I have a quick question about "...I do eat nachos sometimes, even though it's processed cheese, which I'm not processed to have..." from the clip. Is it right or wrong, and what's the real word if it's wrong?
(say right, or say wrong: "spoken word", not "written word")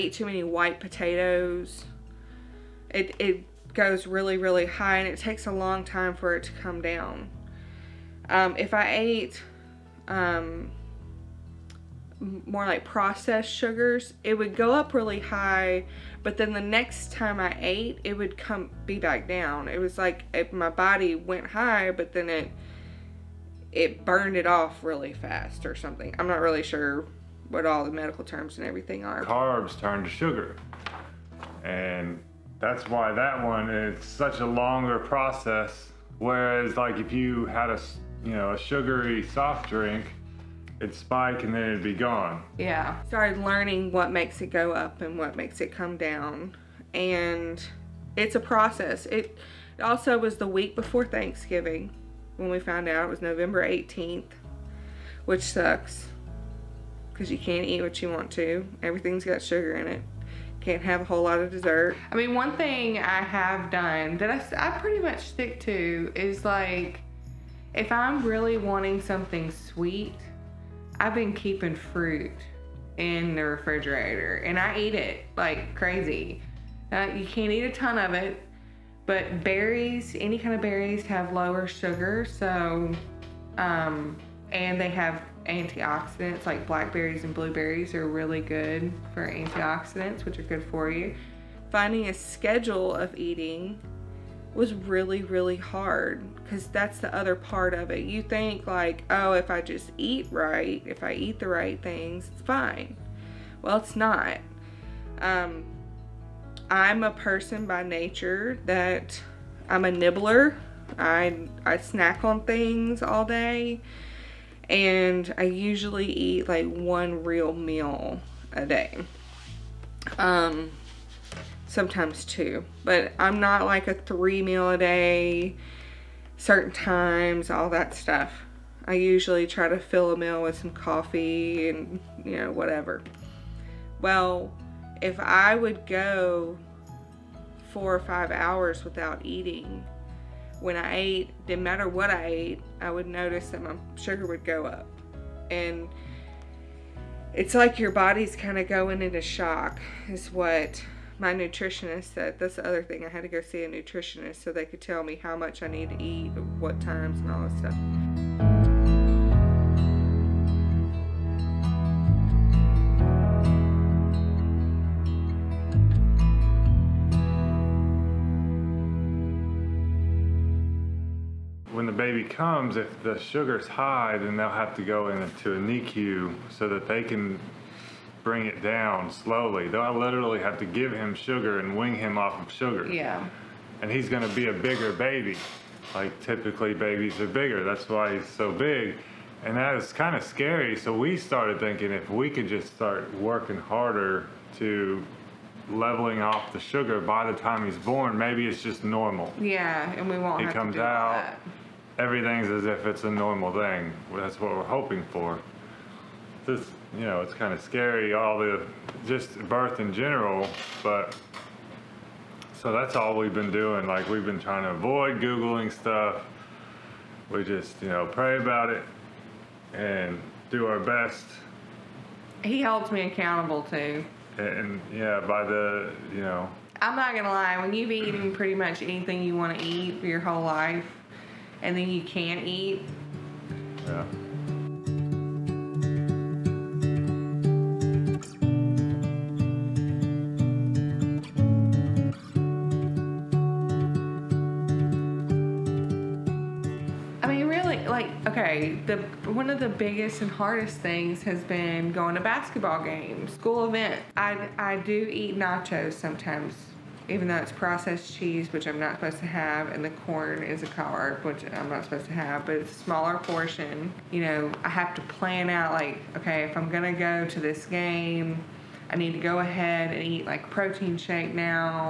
wrong: "supposed", not "processed".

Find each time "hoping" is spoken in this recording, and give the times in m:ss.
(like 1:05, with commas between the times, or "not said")
3:24.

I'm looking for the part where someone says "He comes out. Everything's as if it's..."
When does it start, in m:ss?
3:20.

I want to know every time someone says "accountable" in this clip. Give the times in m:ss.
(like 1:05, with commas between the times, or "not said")
3:43.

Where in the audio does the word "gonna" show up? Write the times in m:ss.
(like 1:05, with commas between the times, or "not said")
3:47, 4:26.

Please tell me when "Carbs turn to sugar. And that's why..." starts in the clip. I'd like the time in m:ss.
0:29.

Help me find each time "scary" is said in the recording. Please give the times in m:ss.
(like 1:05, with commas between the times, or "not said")
3:10, 3:27.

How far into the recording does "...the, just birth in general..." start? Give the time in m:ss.
3:28.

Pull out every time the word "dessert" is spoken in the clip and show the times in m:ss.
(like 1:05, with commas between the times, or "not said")
1:01.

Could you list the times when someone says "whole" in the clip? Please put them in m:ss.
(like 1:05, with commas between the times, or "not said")
1:01, 3:50.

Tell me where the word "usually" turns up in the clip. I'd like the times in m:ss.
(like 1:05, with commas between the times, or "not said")
1:55, 2:08.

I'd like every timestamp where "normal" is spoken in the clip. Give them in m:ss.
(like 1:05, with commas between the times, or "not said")
3:18, 3:23.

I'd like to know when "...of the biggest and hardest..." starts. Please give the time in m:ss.
4:09.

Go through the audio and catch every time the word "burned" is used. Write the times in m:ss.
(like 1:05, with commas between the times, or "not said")
0:24.